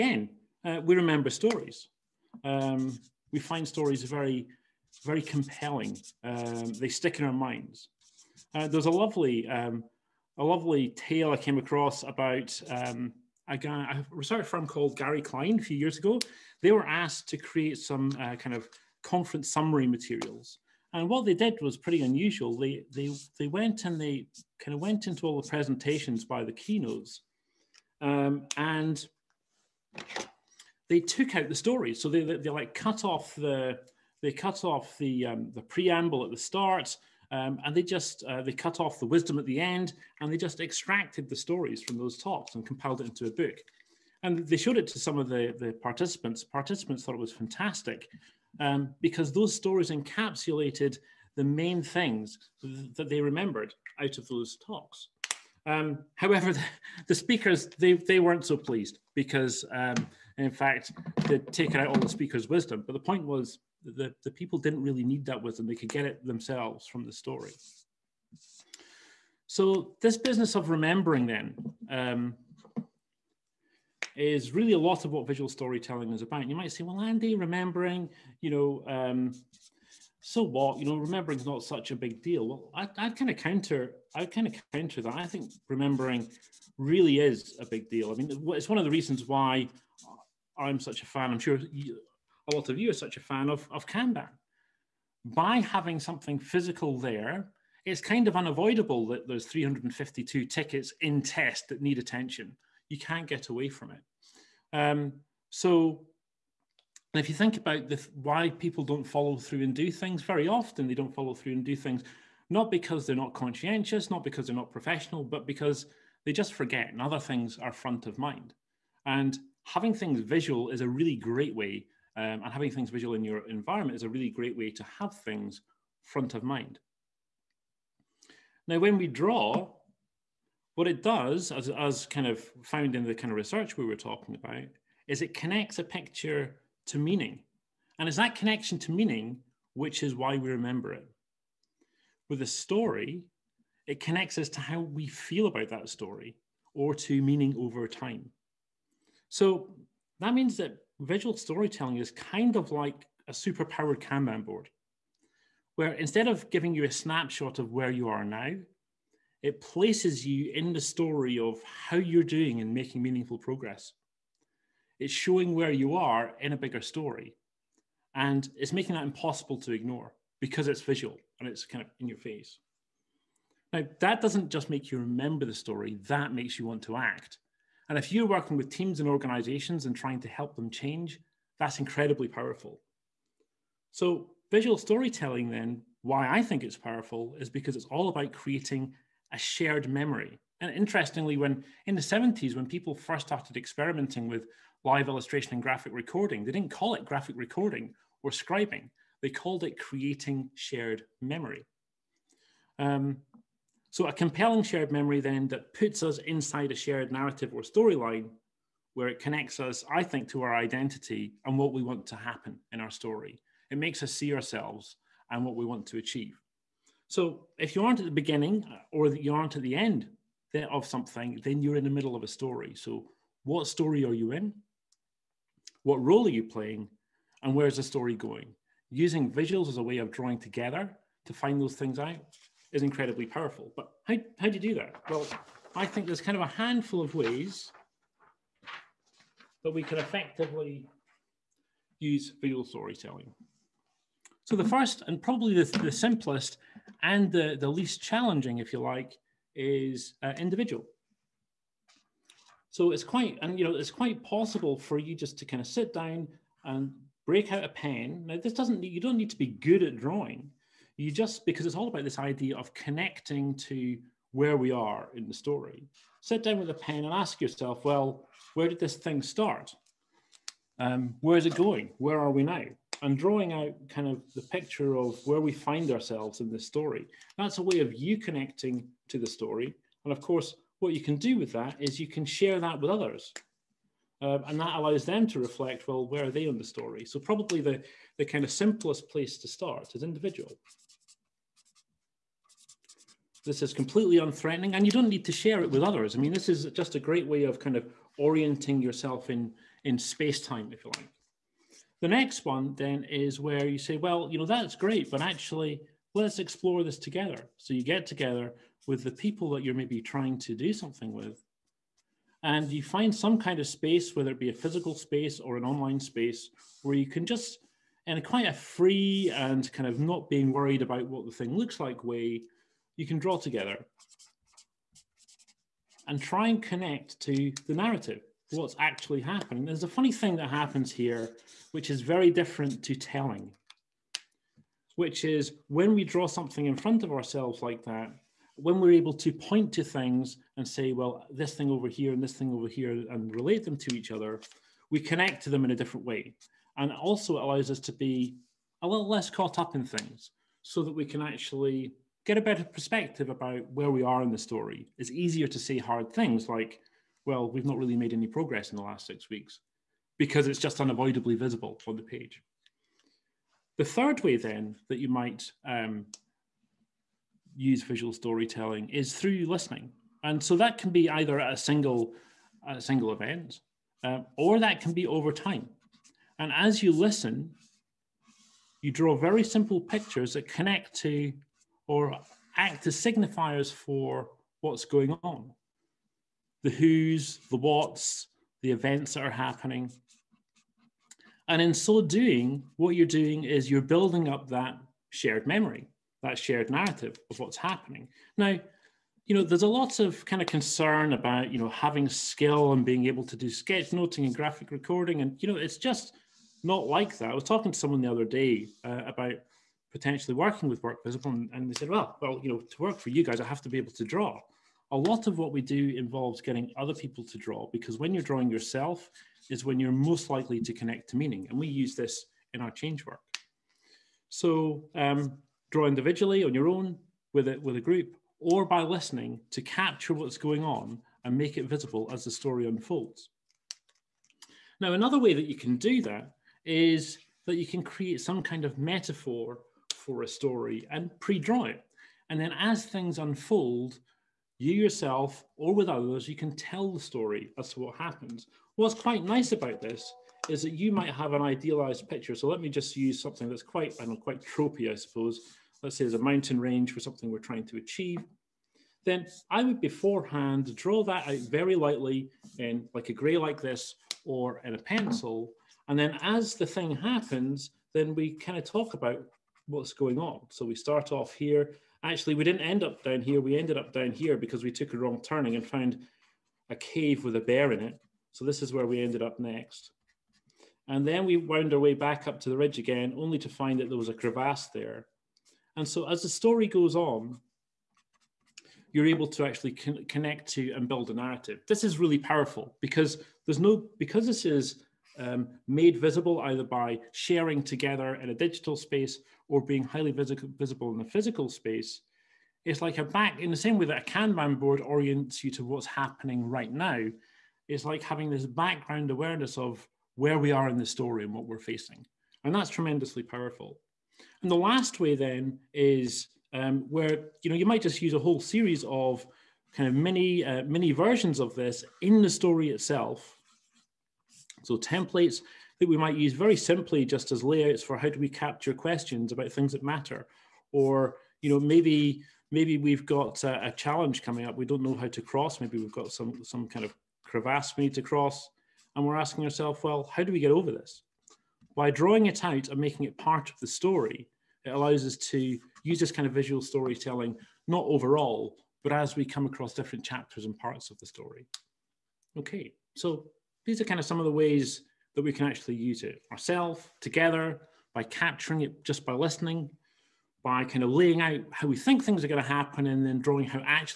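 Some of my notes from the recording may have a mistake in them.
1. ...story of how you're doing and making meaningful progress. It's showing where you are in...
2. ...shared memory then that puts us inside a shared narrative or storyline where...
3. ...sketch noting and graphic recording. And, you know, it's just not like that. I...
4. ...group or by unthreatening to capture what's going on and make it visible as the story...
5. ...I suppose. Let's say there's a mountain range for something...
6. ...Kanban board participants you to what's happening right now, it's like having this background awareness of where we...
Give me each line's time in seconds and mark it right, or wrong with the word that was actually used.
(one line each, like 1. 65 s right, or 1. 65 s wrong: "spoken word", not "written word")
1. 160 s right
2. 204 s right
3. 403 s right
4. 427 s wrong: "listening", not "unthreatening"
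5. 454 s right
6. 504 s wrong: "orients", not "participants".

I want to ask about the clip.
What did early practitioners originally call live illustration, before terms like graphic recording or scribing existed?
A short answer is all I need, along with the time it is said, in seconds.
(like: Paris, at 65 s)
Creating shared memory, at 199 s.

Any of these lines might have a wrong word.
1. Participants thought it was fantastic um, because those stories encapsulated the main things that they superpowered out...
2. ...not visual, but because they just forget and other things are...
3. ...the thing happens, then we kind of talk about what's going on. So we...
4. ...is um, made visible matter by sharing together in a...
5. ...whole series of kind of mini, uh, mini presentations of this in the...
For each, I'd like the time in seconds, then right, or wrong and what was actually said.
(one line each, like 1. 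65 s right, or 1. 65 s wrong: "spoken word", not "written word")
1. 46 s wrong: "remembered", not "superpowered"
2. 114 s wrong: "professional", not "visual"
3. 466 s right
4. 494 s wrong: "either", not "matter"
5. 518 s wrong: "versions", not "presentations".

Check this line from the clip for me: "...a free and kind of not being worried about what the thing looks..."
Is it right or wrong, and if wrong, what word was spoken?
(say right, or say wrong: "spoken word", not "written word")
right.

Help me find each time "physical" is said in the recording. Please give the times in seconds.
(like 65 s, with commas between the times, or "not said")
96 s, 314 s, 501 s.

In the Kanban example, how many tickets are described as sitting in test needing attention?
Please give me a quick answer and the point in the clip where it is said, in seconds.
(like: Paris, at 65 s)
352, at 99 s.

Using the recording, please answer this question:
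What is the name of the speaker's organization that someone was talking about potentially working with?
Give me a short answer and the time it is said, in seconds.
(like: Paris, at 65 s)
WorkVisible, at 410 s.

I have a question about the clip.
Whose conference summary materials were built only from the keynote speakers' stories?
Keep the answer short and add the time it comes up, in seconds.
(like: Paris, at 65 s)
Gary Klein, at 14 s.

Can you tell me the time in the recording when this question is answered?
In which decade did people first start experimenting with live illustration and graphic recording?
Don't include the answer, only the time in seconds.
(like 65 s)
192 s.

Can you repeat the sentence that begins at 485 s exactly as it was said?
And so as the story goes on, you're able to actually con connect to and build a narrative.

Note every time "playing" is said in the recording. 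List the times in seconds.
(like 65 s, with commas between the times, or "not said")
226 s.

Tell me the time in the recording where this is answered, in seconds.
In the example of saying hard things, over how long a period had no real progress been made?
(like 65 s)
359 s.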